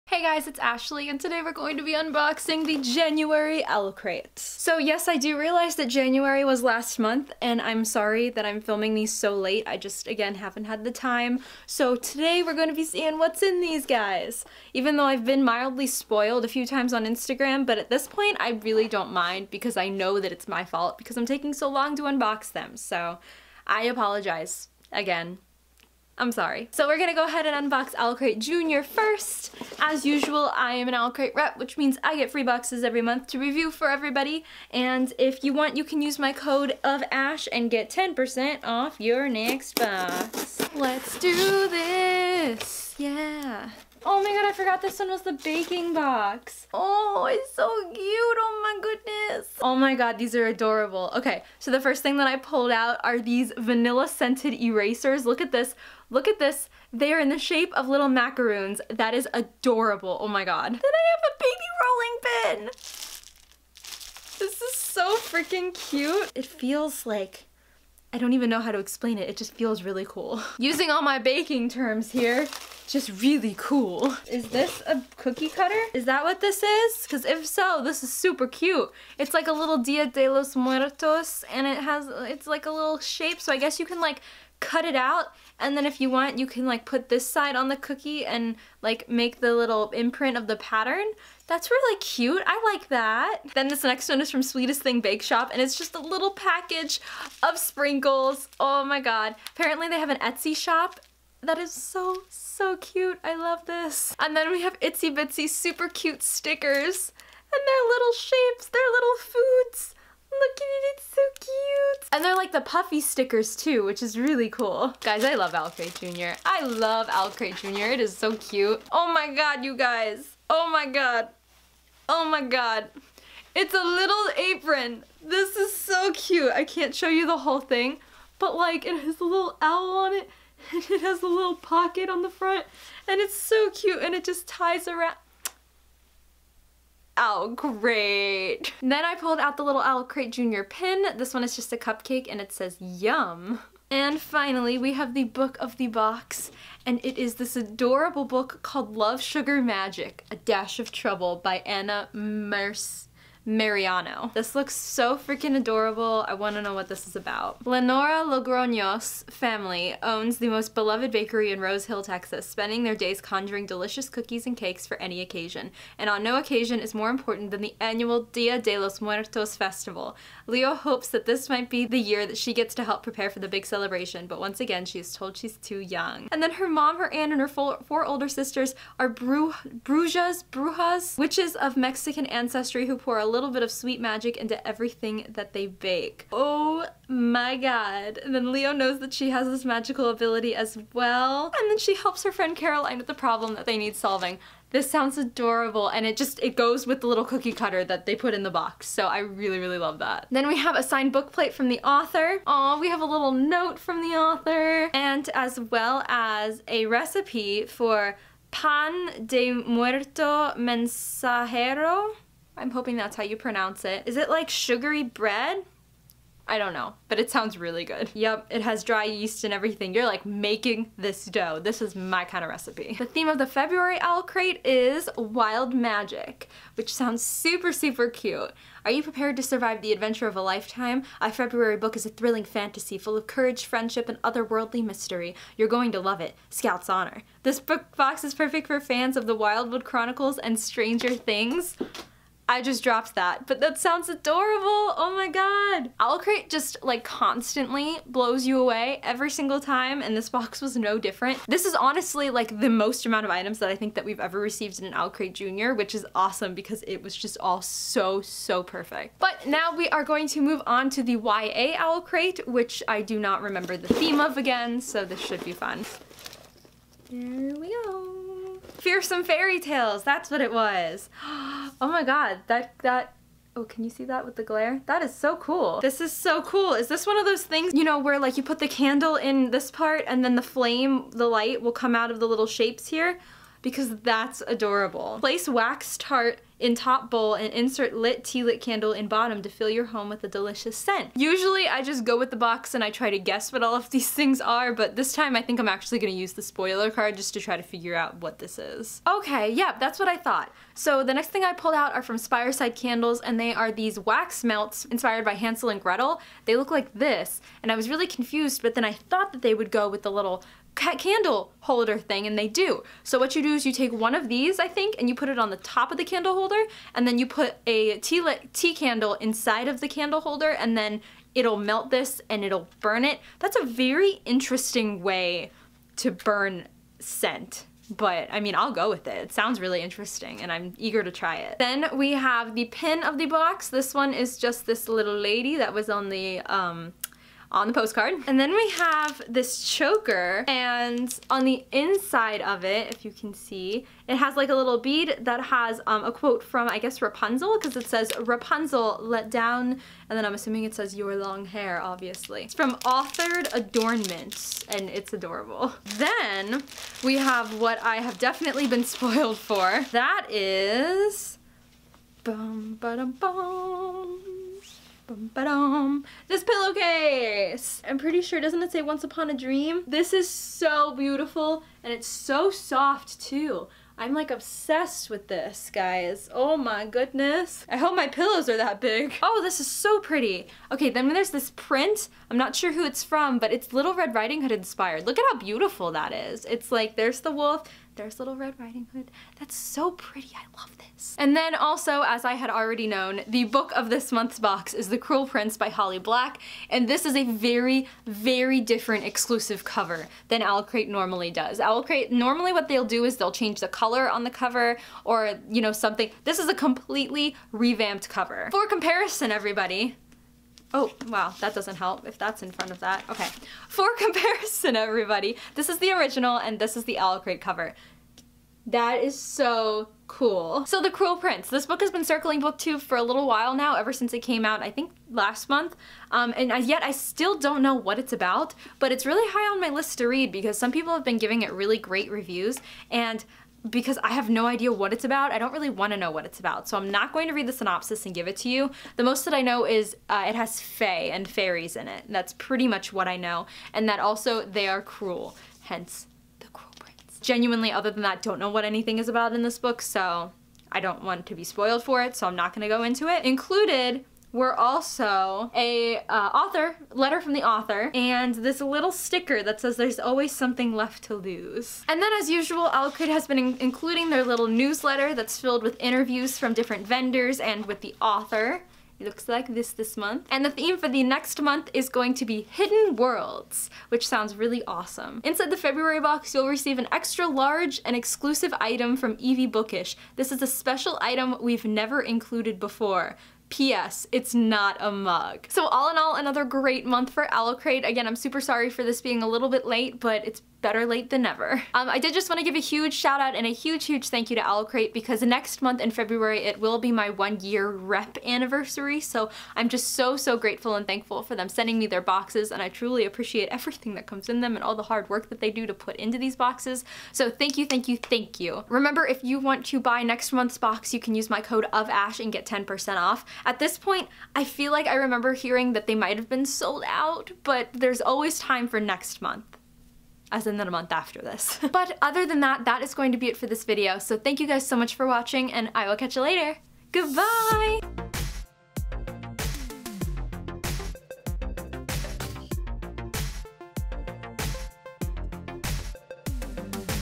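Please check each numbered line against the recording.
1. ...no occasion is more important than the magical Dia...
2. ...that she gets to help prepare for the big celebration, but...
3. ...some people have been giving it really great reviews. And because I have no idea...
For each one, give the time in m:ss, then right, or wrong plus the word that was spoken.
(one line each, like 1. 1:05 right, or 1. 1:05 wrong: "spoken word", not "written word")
1. 2:46 wrong: "annual", not "magical"
2. 2:52 right
3. 7:10 right.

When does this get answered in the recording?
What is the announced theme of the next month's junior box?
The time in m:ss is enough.
3:45.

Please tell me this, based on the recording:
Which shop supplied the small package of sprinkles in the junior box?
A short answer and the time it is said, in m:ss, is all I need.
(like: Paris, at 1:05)
Sweetest Thing Bake Shop, at 1:34.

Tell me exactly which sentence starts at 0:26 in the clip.
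So we're gonna go ahead and unbox Owlcrate Junior first.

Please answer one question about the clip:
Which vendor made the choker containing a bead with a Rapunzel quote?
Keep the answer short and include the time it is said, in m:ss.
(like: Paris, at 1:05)
Authored Adornments, at 5:52.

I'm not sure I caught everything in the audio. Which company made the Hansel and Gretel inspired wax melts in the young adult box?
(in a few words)
Spireside Candles.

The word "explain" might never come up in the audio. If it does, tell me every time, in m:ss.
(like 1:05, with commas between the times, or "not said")
1:08.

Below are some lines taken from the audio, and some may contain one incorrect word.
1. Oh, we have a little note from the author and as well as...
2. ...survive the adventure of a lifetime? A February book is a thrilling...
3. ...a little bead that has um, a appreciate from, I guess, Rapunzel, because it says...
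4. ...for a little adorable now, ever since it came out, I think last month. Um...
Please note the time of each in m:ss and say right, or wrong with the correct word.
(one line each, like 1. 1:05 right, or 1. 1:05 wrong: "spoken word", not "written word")
1. 3:22 right
2. 3:49 right
3. 5:44 wrong: "quote", not "appreciate"
4. 7:02 wrong: "while", not "adorable".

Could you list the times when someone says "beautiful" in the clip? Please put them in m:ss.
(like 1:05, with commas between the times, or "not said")
6:10, 6:25.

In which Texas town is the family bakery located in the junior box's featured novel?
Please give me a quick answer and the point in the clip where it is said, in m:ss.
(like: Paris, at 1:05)
Rose Hill, at 2:41.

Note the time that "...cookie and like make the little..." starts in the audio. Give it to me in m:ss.
1:27.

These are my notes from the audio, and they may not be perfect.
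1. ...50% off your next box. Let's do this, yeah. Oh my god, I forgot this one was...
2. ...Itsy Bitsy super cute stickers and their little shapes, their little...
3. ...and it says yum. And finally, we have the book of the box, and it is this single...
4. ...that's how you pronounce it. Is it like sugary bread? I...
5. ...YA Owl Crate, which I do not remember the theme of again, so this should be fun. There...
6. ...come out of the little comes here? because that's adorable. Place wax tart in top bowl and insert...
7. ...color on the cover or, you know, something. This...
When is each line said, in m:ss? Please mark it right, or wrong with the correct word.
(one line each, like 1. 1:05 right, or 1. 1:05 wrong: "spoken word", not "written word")
1. 0:37 wrong: "10", not "50"
2. 1:44 right
3. 2:22 wrong: "adorable", not "single"
4. 3:32 right
5. 4:21 right
6. 4:41 wrong: "shapes", not "comes"
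7. 6:43 right.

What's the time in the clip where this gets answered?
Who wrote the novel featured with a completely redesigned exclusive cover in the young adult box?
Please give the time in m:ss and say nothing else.
6:35.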